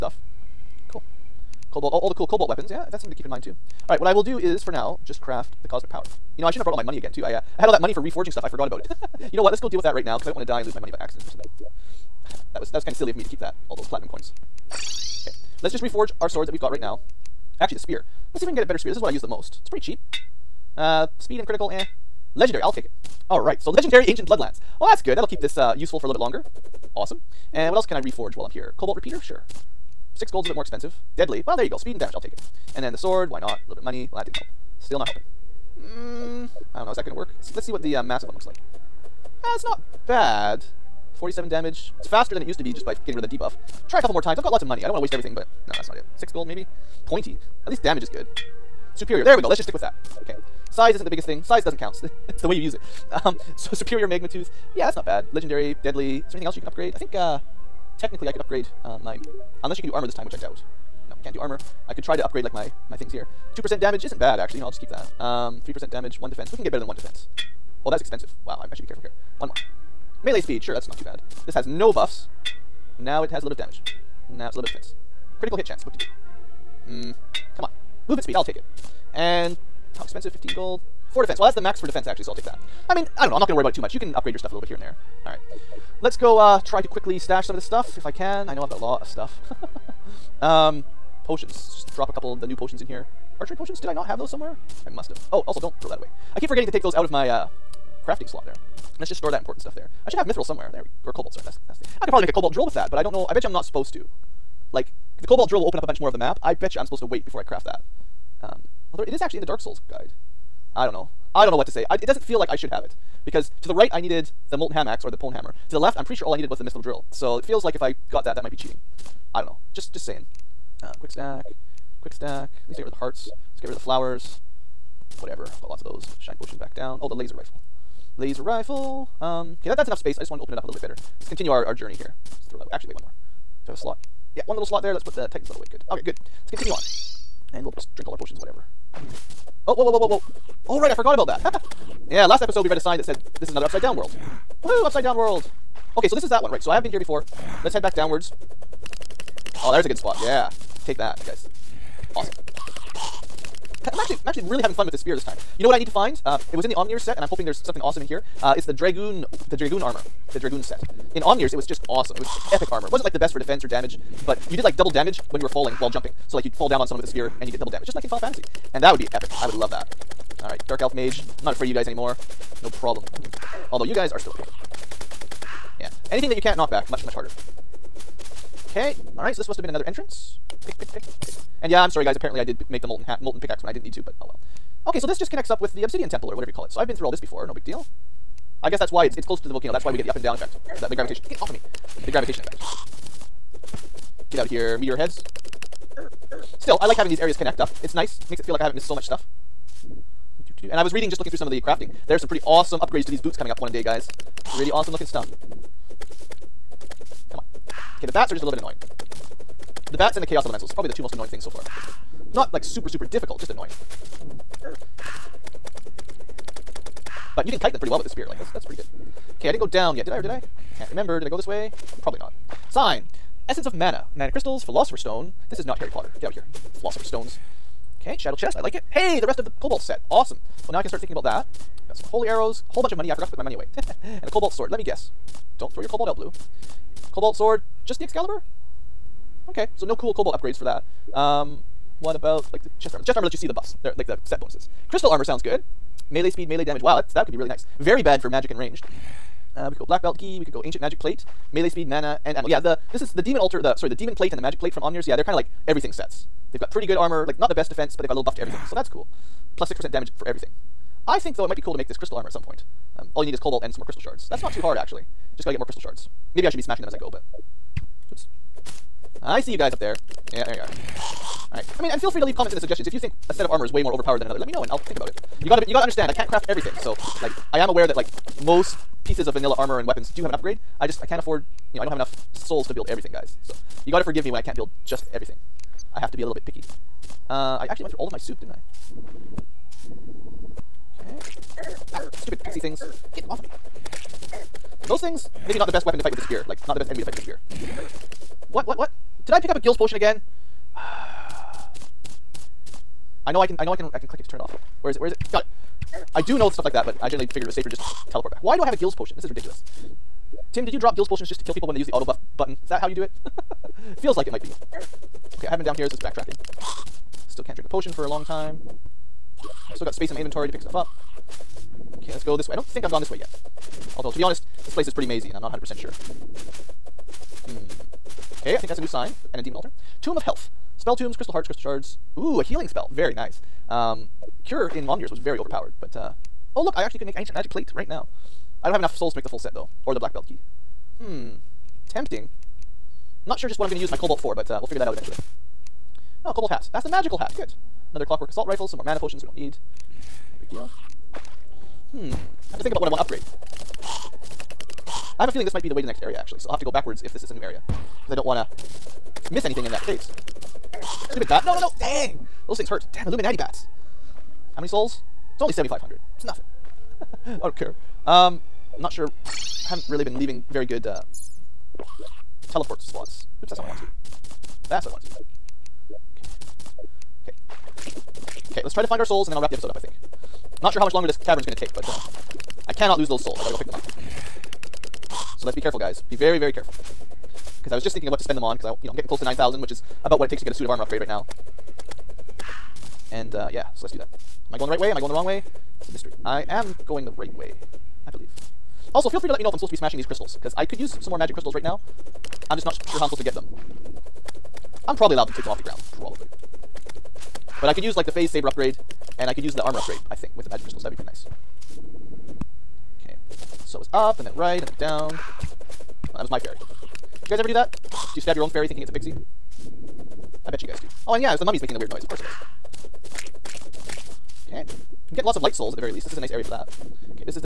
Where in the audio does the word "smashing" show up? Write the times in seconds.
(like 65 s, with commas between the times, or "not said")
266 s, 399 s.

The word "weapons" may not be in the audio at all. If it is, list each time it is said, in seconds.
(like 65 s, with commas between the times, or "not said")
2 s, 279 s, 295 s.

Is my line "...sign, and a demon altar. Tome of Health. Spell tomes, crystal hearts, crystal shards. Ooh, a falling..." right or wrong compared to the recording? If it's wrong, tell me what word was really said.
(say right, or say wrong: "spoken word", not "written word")
wrong: "healing", not "falling".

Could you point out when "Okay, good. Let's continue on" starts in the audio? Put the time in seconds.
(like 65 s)
135 s.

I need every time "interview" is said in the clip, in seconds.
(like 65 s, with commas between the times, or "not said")
not said.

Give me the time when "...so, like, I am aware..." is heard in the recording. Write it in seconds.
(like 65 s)
276 s.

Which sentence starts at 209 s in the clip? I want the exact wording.
The bats and the chaos elementals.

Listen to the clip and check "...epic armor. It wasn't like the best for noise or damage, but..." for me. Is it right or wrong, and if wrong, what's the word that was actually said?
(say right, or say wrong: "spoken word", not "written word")
wrong: "defense", not "noise".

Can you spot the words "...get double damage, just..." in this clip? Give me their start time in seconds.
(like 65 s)
167 s.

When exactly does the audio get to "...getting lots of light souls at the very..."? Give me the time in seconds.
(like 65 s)
425 s.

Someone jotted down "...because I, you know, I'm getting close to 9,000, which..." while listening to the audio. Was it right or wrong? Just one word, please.
right.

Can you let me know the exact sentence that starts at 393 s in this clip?
And uh, yeah, so let's do that.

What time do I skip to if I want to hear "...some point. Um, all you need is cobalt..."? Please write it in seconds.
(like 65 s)
262 s.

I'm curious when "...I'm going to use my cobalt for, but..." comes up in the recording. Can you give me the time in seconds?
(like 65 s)
343 s.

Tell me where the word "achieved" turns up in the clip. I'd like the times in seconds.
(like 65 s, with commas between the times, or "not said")
not said.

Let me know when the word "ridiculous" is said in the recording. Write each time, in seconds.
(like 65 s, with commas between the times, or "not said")
309 s.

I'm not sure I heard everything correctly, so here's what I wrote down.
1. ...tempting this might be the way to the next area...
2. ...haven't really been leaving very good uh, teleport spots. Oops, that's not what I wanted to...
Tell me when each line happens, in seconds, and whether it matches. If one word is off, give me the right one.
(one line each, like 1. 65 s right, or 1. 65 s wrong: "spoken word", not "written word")
1. 355 s wrong: "feeling", not "tempting"
2. 369 s right.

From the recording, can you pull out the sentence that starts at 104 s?
Like the cobalt drill will open up a bunch more of the map.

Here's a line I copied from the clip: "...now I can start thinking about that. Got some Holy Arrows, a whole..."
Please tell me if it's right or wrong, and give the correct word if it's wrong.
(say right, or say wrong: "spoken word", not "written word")
right.